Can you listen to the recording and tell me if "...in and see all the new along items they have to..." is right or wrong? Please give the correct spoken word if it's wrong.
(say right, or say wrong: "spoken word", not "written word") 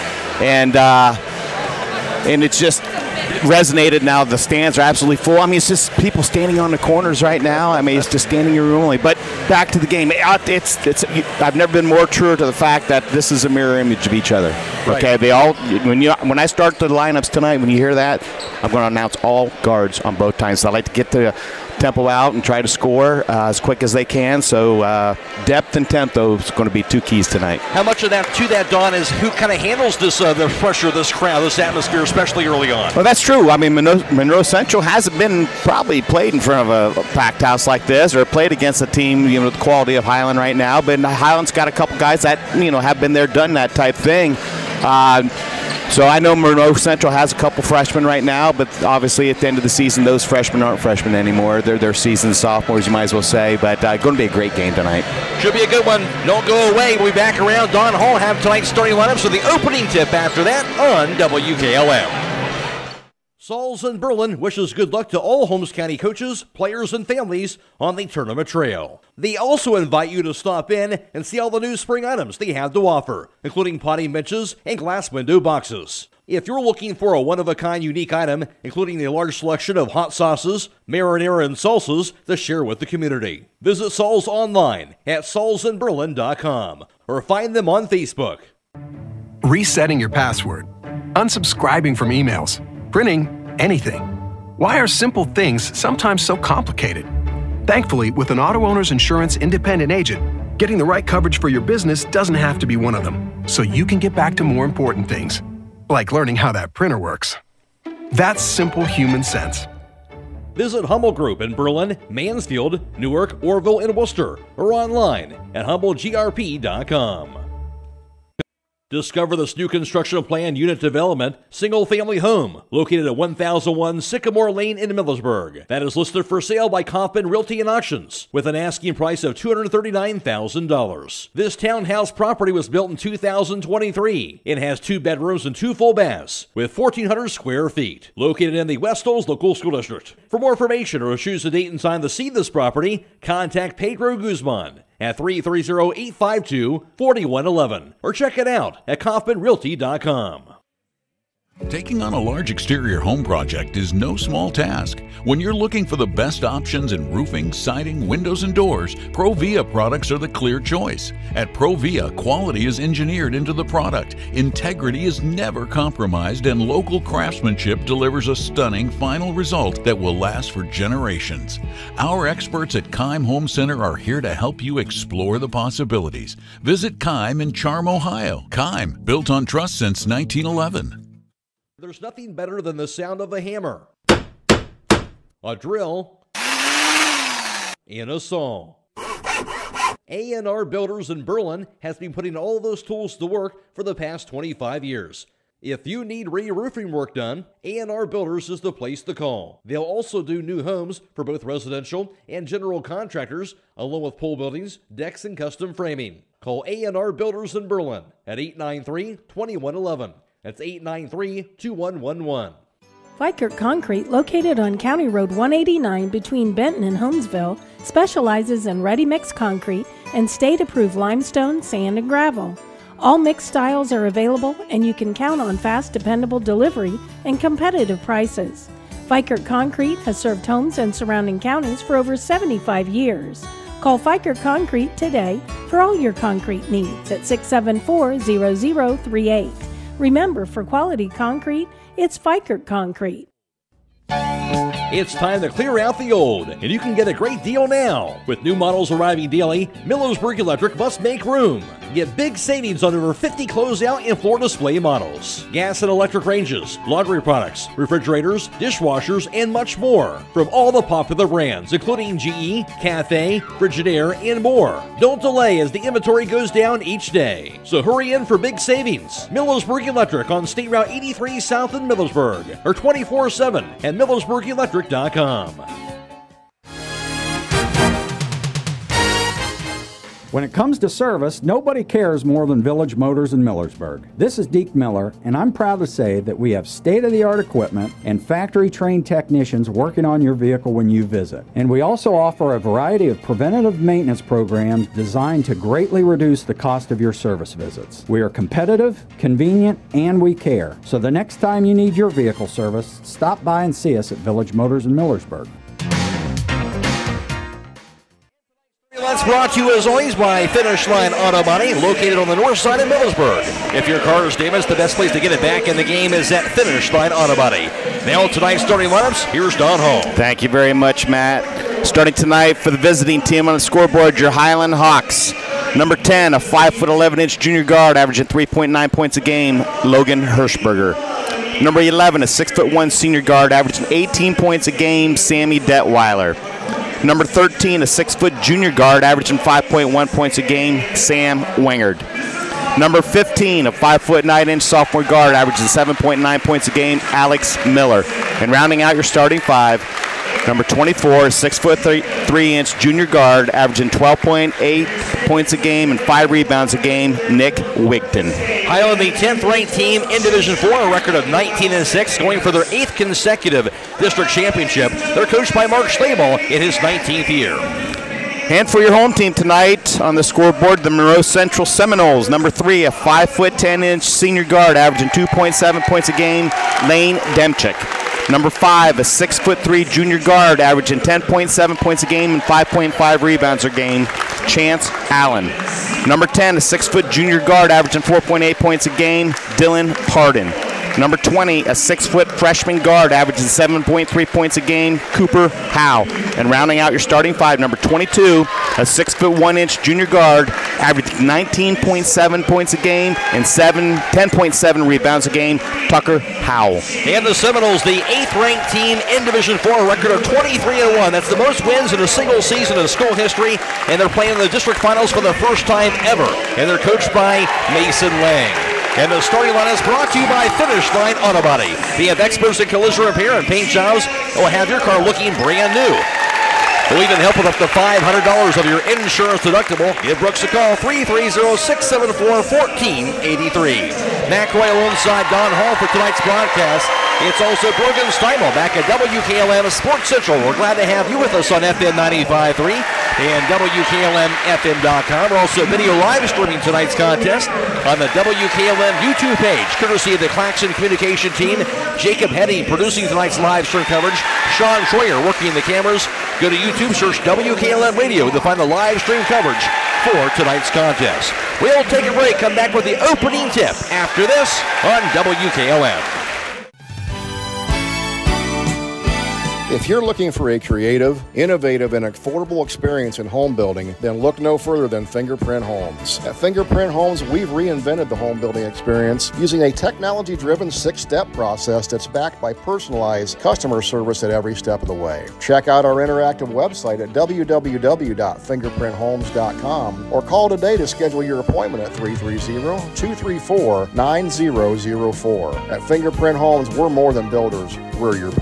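wrong: "spring", not "along".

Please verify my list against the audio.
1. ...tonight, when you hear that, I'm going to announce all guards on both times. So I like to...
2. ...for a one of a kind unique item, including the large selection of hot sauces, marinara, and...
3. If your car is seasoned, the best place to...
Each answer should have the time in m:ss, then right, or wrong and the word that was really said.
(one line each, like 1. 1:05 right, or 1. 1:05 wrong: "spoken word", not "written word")
1. 0:17 right
2. 1:16 right
3. 5:13 wrong: "damaged", not "seasoned".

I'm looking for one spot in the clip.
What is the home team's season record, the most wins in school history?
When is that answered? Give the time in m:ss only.
6:50.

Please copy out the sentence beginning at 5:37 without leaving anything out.
Number 13, a six foot junior guard, averaging 5.1 points a game, Sam Wingard.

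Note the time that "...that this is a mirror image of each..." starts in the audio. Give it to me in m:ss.
0:12.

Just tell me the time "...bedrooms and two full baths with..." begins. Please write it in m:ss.
2:15.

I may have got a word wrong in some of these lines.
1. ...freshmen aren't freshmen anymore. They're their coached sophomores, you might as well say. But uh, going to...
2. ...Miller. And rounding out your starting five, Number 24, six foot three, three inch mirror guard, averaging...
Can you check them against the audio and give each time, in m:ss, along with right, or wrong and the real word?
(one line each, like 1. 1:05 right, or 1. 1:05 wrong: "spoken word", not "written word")
1. 0:50 wrong: "seasoned", not "coached"
2. 5:47 wrong: "junior", not "mirror".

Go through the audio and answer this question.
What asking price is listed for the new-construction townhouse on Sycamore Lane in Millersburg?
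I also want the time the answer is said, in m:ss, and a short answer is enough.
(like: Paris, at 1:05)
$239,000, at 2:09.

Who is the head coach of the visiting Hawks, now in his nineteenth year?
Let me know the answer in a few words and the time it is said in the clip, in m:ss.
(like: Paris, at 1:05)
Mark Stabel, at 6:05.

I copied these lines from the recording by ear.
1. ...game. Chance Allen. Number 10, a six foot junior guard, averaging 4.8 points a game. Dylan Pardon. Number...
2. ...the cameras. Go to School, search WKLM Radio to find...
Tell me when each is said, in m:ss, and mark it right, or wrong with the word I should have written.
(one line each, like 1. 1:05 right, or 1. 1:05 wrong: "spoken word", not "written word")
1. 6:23 right
2. 7:35 wrong: "YouTube", not "School".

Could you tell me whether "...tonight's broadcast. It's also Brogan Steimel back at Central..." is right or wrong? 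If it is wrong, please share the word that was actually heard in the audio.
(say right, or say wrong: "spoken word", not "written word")
wrong: "WKLM", not "Central".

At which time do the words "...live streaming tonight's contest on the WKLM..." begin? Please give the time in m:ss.
7:25.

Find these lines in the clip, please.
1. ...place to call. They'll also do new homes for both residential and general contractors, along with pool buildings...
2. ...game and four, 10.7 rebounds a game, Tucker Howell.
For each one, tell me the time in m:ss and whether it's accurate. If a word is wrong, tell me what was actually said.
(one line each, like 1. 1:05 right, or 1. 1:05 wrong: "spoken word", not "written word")
1. 3:18 right
2. 6:42 wrong: "seven", not "four".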